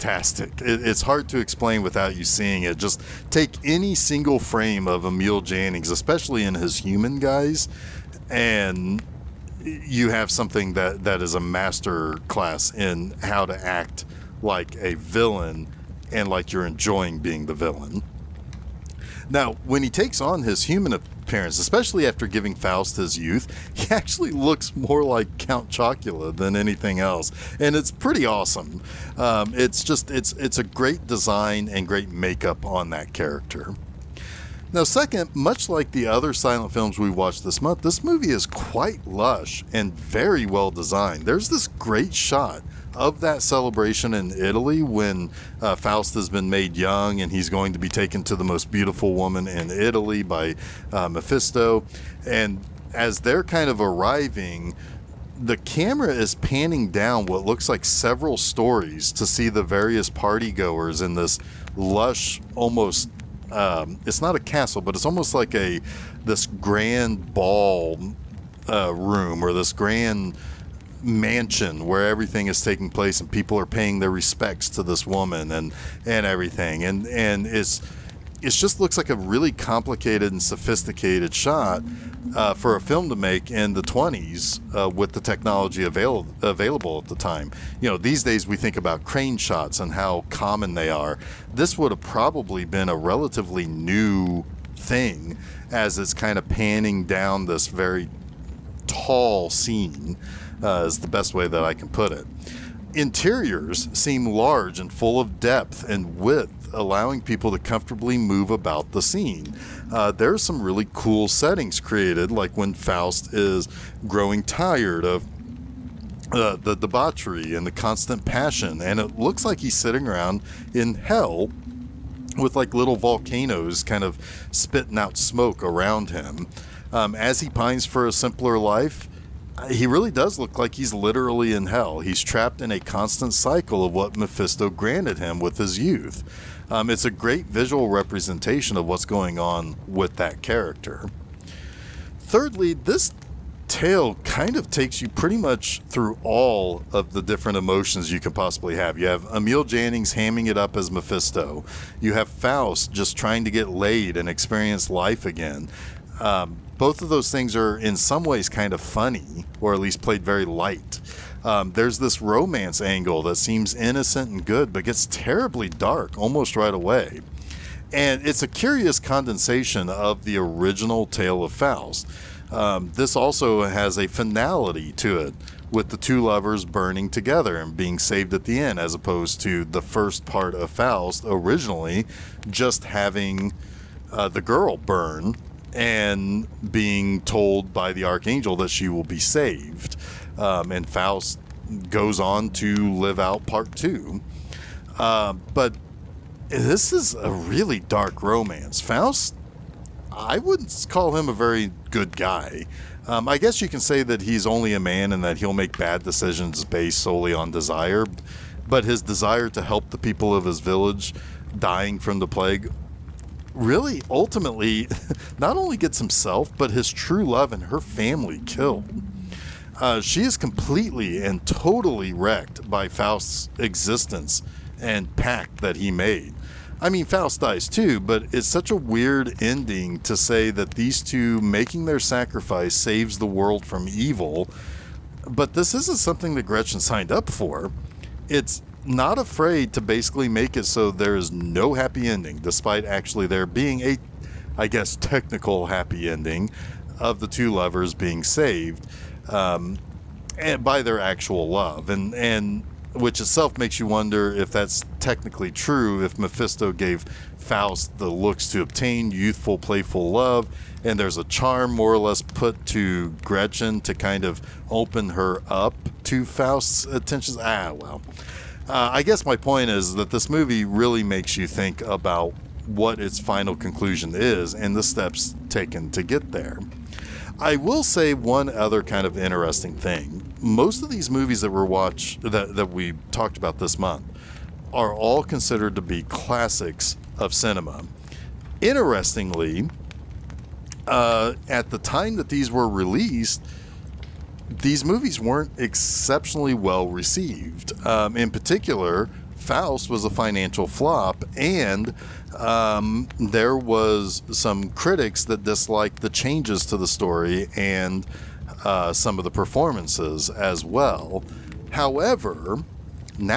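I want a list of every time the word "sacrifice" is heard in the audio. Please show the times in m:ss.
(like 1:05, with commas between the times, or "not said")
3:51.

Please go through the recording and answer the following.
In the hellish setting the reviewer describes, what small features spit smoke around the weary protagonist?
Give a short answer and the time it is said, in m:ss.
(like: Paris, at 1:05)
Volcanoes, at 2:02.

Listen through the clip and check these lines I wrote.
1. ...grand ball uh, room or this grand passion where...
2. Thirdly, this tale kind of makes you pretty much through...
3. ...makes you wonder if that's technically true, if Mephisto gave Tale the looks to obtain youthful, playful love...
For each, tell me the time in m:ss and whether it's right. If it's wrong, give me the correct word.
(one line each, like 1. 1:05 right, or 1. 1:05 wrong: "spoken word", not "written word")
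1. 1:06 wrong: "mansion", not "passion"
2. 2:22 wrong: "takes", not "makes"
3. 4:13 wrong: "Faust", not "Tale".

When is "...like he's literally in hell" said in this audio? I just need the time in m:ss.
2:10.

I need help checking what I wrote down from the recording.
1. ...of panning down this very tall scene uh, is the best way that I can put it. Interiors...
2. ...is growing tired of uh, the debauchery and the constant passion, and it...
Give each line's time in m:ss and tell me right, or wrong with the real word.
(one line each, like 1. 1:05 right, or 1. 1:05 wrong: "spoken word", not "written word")
1. 1:36 right
2. 1:53 right.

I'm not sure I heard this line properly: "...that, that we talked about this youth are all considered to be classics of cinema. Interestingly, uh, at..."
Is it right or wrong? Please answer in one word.
wrong.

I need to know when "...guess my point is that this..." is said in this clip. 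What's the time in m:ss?
4:29.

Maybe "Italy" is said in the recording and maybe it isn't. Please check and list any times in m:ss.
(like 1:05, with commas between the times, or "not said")
0:44, 0:49.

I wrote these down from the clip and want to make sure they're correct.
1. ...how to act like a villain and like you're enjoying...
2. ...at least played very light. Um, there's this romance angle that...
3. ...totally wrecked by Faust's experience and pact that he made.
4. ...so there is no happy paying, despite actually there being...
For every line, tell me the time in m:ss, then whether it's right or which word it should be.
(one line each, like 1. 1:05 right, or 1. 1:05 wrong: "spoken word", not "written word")
1. 0:13 right
2. 2:39 right
3. 3:41 wrong: "existence", not "experience"
4. 4:00 wrong: "ending", not "paying".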